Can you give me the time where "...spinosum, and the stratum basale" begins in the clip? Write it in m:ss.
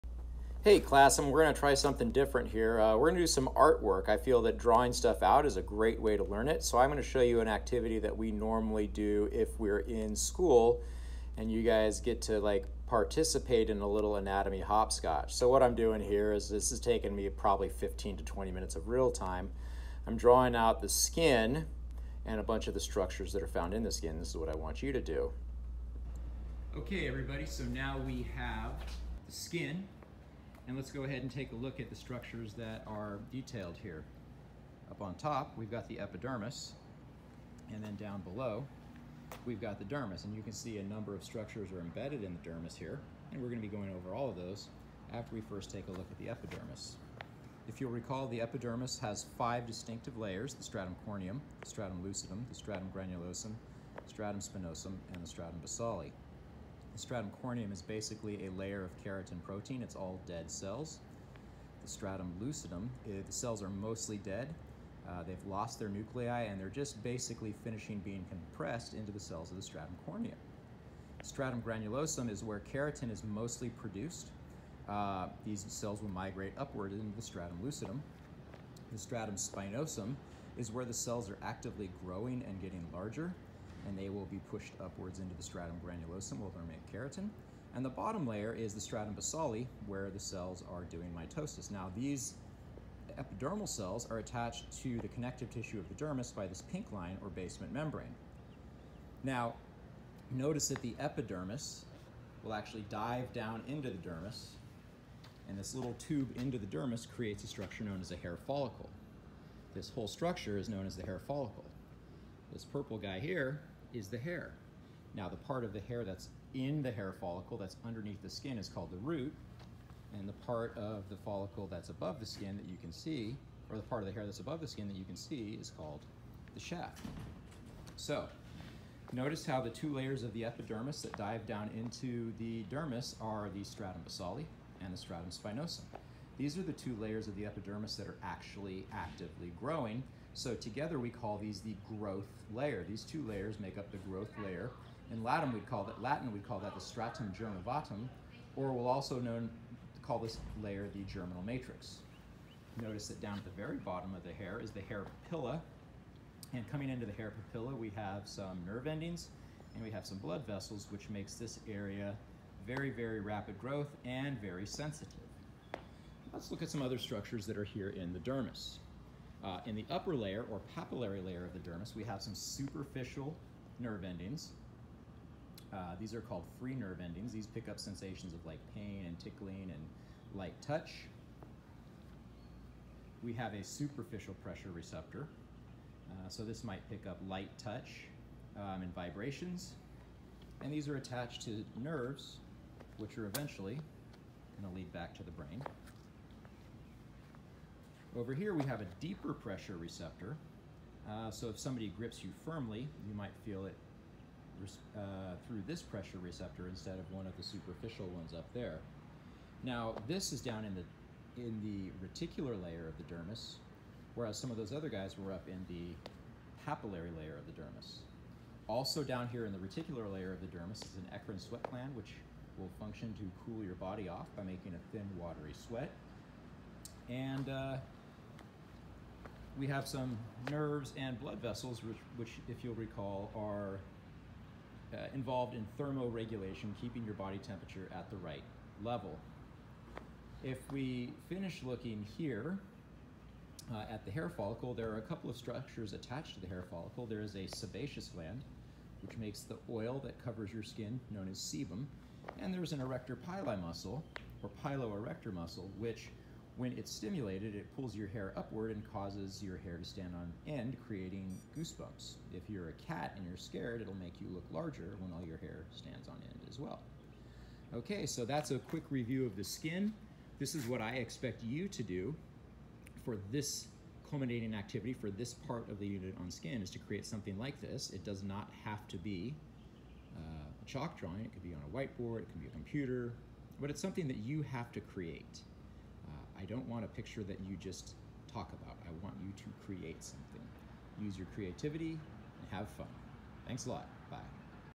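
0:54.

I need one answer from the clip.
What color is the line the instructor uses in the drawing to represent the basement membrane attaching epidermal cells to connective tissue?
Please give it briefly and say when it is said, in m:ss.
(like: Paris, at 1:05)
Pink, at 1:36.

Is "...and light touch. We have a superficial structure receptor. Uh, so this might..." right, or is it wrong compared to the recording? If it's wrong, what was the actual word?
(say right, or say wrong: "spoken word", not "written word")
wrong: "pressure", not "structure".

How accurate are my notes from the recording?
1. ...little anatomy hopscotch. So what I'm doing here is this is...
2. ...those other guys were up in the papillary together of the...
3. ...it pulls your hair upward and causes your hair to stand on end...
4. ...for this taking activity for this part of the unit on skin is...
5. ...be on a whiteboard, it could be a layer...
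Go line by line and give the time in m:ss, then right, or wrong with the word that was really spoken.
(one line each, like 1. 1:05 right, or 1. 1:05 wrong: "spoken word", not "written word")
1. 0:13 right
2. 3:34 wrong: "layer", not "together"
3. 4:17 right
4. 4:33 wrong: "culminating", not "taking"
5. 4:41 wrong: "computer", not "layer".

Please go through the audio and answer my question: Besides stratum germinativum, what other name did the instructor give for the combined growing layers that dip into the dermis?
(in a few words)
Germinal matrix.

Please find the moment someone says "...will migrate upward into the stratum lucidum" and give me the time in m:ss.
1:16.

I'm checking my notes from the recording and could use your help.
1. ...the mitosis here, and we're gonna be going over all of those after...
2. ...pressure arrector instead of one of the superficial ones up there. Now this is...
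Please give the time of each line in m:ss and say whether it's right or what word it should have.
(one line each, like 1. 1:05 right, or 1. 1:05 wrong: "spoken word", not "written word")
1. 0:42 wrong: "dermis", not "mitosis"
2. 3:25 wrong: "receptor", not "arrector".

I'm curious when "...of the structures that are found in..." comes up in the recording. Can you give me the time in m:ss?
0:22.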